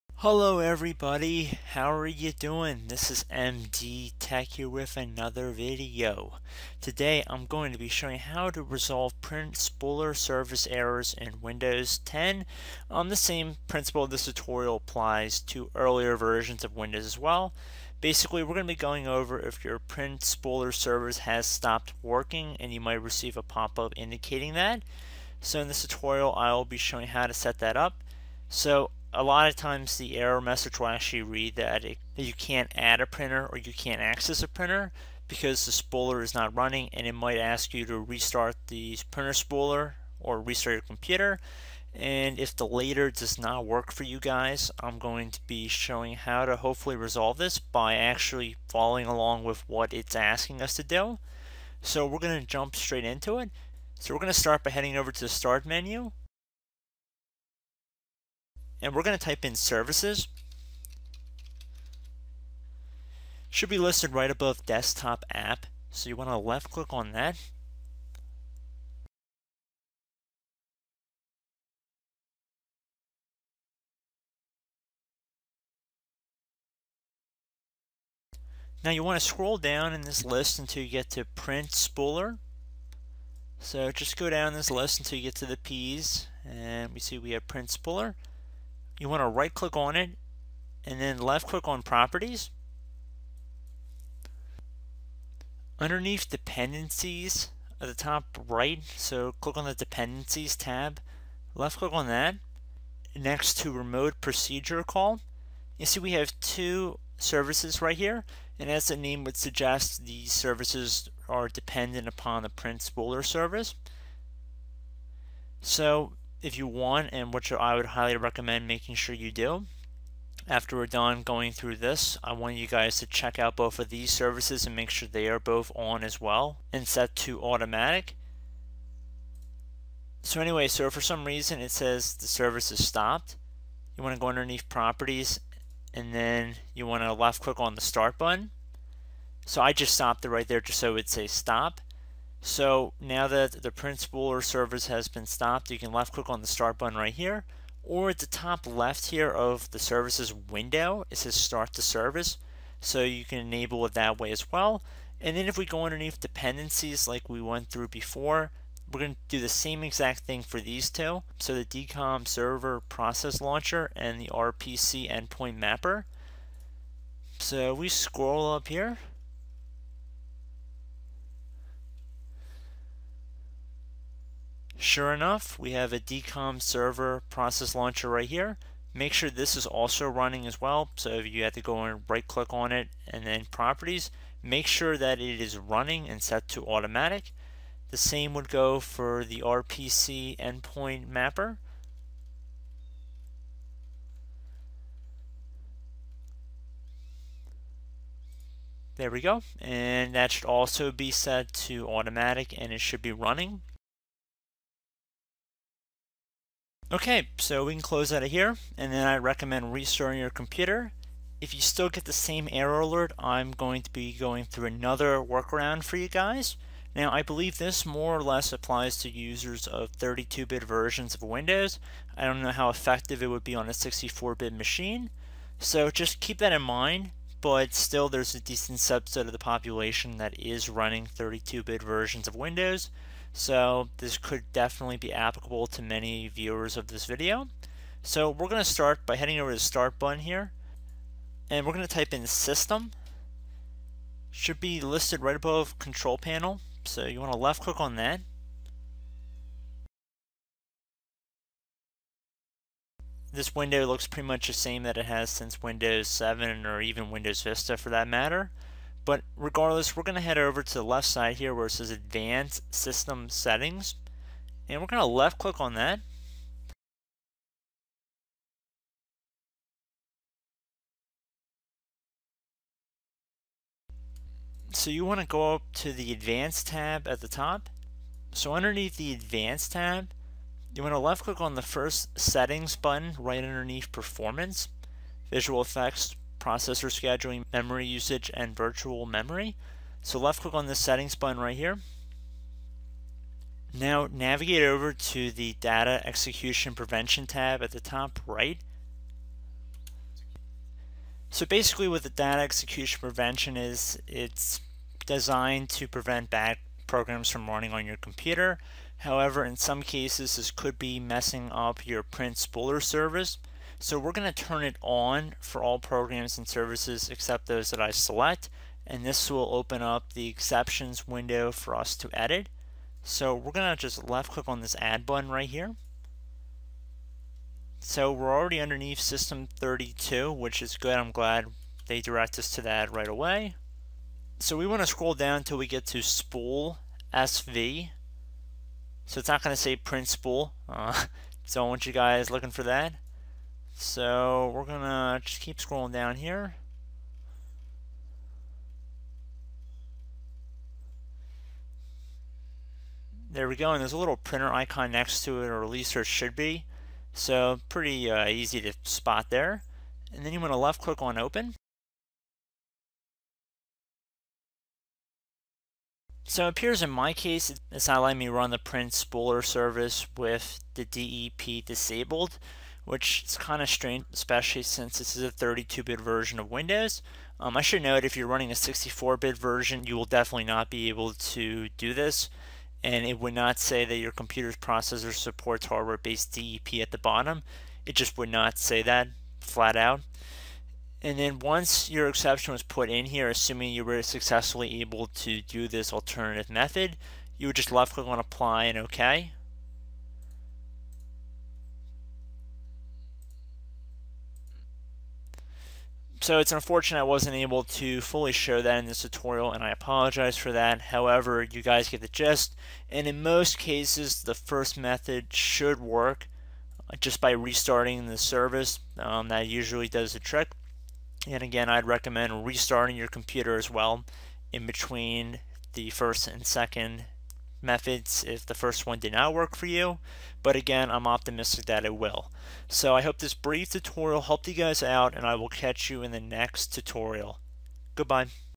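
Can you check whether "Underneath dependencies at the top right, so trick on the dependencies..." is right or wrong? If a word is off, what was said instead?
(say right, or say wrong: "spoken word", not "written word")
wrong: "click", not "trick".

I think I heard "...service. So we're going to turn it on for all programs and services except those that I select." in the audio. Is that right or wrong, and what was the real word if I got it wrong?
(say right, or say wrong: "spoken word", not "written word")
right.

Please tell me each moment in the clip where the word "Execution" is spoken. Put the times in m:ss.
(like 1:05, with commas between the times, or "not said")
4:56, 5:02.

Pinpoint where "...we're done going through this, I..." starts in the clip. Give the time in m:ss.
2:00.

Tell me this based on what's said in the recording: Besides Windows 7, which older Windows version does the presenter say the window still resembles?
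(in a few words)
Windows Vista.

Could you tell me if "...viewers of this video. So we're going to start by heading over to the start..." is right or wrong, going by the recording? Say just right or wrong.
right.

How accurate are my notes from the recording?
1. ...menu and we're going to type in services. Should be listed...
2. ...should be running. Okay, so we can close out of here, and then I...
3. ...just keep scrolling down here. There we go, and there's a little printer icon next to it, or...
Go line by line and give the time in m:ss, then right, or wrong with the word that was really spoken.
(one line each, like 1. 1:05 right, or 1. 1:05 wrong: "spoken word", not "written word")
1. 0:55 right
2. 3:22 right
3. 5:45 right.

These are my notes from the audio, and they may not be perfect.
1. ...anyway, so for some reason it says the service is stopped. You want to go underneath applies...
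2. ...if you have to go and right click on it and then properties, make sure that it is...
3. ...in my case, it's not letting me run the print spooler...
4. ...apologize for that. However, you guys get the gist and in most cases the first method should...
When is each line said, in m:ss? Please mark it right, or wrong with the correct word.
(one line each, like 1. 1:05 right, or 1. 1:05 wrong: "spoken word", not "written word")
1. 2:10 wrong: "properties", not "applies"
2. 3:01 right
3. 6:06 right
4. 6:49 right.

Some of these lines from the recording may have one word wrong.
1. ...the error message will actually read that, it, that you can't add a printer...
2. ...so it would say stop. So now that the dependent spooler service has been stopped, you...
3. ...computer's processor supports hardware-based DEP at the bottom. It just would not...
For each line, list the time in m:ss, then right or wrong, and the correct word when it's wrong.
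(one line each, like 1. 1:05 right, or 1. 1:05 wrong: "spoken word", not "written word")
1. 0:29 right
2. 2:20 wrong: "print", not "dependent"
3. 6:24 right.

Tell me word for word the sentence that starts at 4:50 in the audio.
So left click on this settings button right here.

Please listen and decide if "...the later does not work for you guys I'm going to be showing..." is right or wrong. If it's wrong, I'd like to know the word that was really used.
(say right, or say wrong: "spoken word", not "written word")
right.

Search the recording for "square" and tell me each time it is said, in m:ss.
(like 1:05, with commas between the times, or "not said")
not said.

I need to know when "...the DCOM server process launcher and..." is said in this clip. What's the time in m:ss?
2:41.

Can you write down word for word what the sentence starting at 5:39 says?
So it's not going to say print spool.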